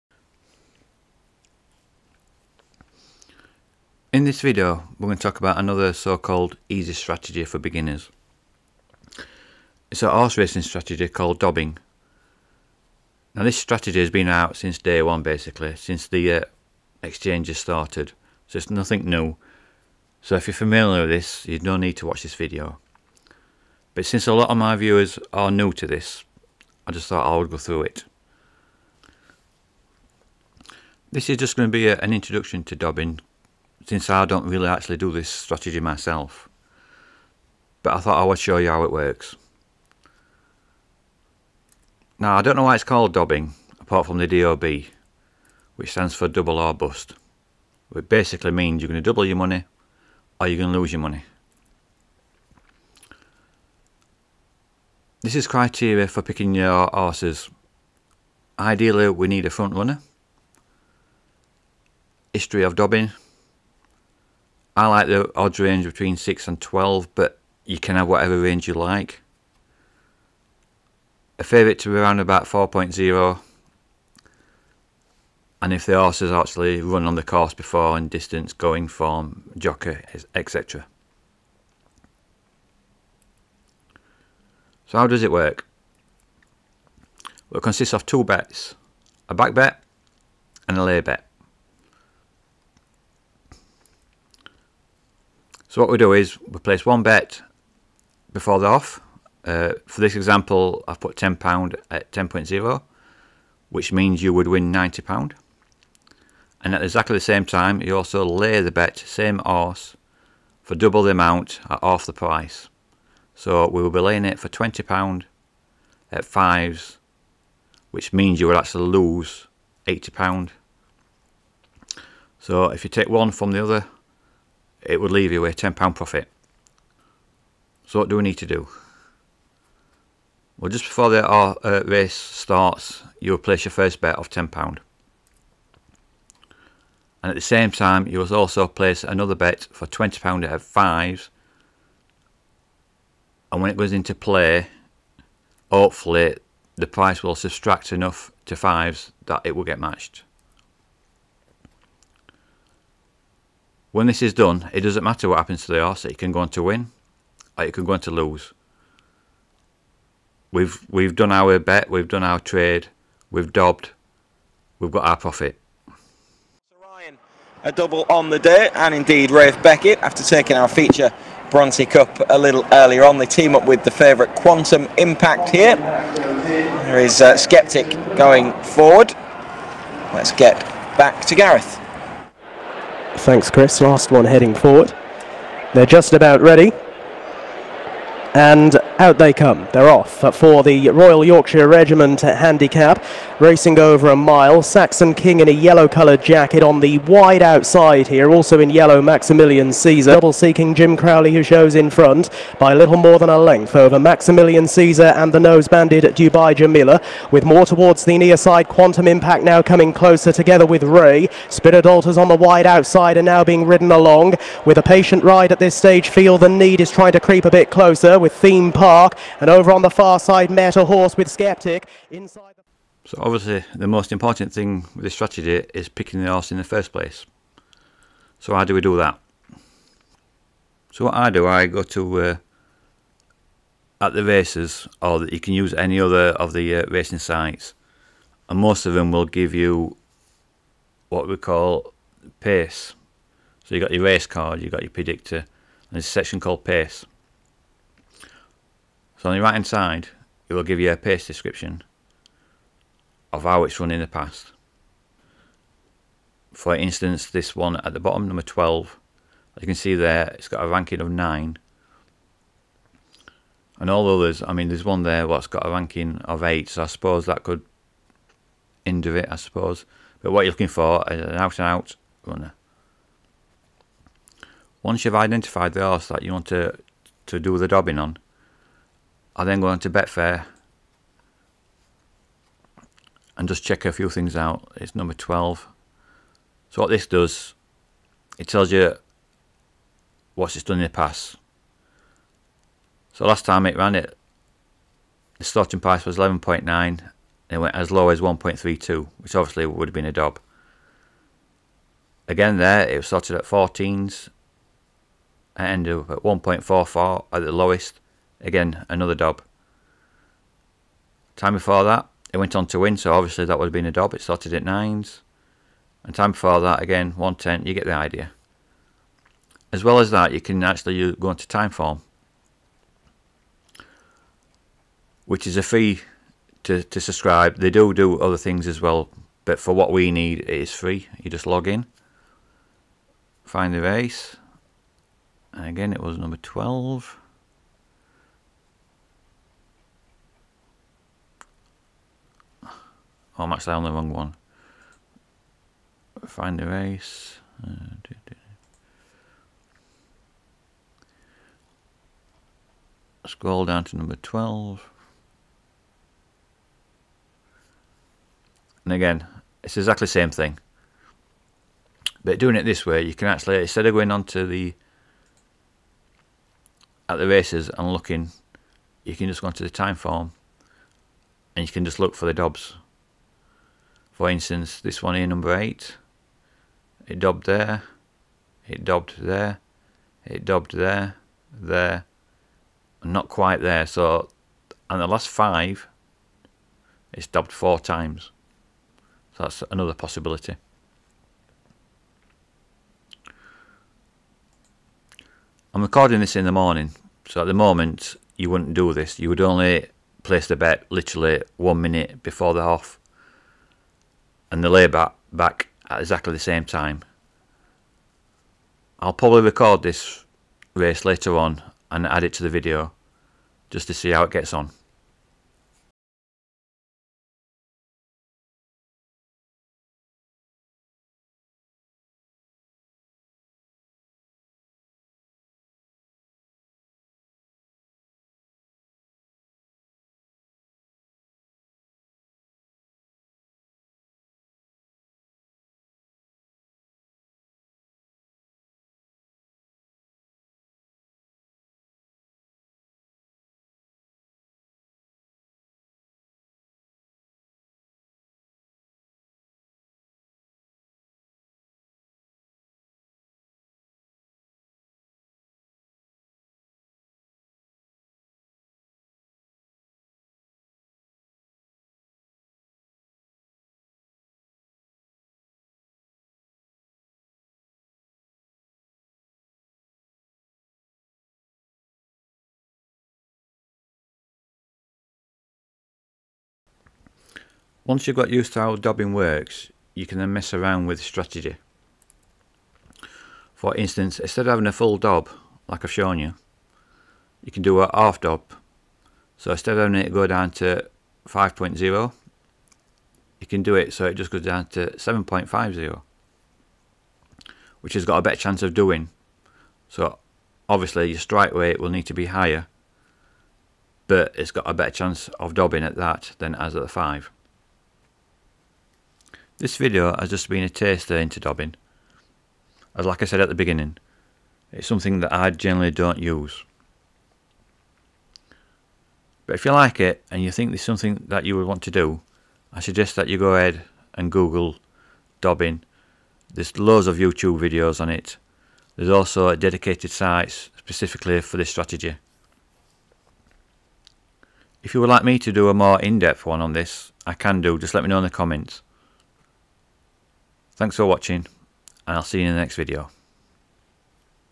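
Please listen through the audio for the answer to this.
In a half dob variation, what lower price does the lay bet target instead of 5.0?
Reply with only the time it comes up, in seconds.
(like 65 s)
494 s.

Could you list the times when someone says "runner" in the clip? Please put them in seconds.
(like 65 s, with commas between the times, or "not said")
59 s, 272 s.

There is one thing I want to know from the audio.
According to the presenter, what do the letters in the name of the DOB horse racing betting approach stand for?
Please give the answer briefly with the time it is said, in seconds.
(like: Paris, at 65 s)
double or bust, at 46 s.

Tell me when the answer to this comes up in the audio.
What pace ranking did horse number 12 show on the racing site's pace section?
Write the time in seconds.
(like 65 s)
261 s.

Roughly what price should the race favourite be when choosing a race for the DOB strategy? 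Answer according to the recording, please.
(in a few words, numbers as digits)
4.0.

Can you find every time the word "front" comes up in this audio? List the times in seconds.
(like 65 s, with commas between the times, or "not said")
59 s, 201 s.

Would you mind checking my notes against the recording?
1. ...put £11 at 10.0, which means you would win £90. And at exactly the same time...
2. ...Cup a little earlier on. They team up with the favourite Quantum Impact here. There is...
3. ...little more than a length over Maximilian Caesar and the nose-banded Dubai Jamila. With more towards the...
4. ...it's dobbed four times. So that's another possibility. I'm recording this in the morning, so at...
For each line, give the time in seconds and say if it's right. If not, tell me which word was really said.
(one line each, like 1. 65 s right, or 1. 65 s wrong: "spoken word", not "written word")
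1. 100 s wrong: "10", not "11"
2. 171 s right
3. 202 s right
4. 387 s right.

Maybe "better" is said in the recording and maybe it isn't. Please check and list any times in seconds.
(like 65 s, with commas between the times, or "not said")
498 s, 504 s.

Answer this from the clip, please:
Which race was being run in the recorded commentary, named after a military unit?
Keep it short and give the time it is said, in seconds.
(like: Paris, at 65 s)
Royal Yorkshire Regiment handicap, at 190 s.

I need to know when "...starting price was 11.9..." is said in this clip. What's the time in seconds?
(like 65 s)
295 s.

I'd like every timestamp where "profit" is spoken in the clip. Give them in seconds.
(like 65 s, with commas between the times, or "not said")
125 s, 165 s.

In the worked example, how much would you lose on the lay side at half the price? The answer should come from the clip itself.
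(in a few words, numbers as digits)
£80.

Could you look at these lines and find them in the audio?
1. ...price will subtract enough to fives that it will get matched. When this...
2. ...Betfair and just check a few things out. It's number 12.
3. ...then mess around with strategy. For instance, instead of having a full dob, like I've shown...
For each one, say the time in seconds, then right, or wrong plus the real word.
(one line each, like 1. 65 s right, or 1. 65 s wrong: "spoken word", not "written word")
1. 146 s right
2. 279 s right
3. 480 s right.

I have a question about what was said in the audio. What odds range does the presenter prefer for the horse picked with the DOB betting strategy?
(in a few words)
between 6 and 12.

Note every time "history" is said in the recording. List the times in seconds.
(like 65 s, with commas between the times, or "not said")
62 s.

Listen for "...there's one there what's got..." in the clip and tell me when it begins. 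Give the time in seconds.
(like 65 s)
264 s.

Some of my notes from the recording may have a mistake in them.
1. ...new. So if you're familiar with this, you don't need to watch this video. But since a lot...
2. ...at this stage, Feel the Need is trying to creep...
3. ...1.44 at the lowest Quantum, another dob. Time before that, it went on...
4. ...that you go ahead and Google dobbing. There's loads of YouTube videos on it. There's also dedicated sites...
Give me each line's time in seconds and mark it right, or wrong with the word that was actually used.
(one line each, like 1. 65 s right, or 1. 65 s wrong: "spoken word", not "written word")
1. 19 s right
2. 215 s right
3. 306 s wrong: "Again", not "Quantum"
4. 523 s right.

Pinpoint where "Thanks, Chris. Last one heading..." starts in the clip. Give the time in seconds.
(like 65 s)
183 s.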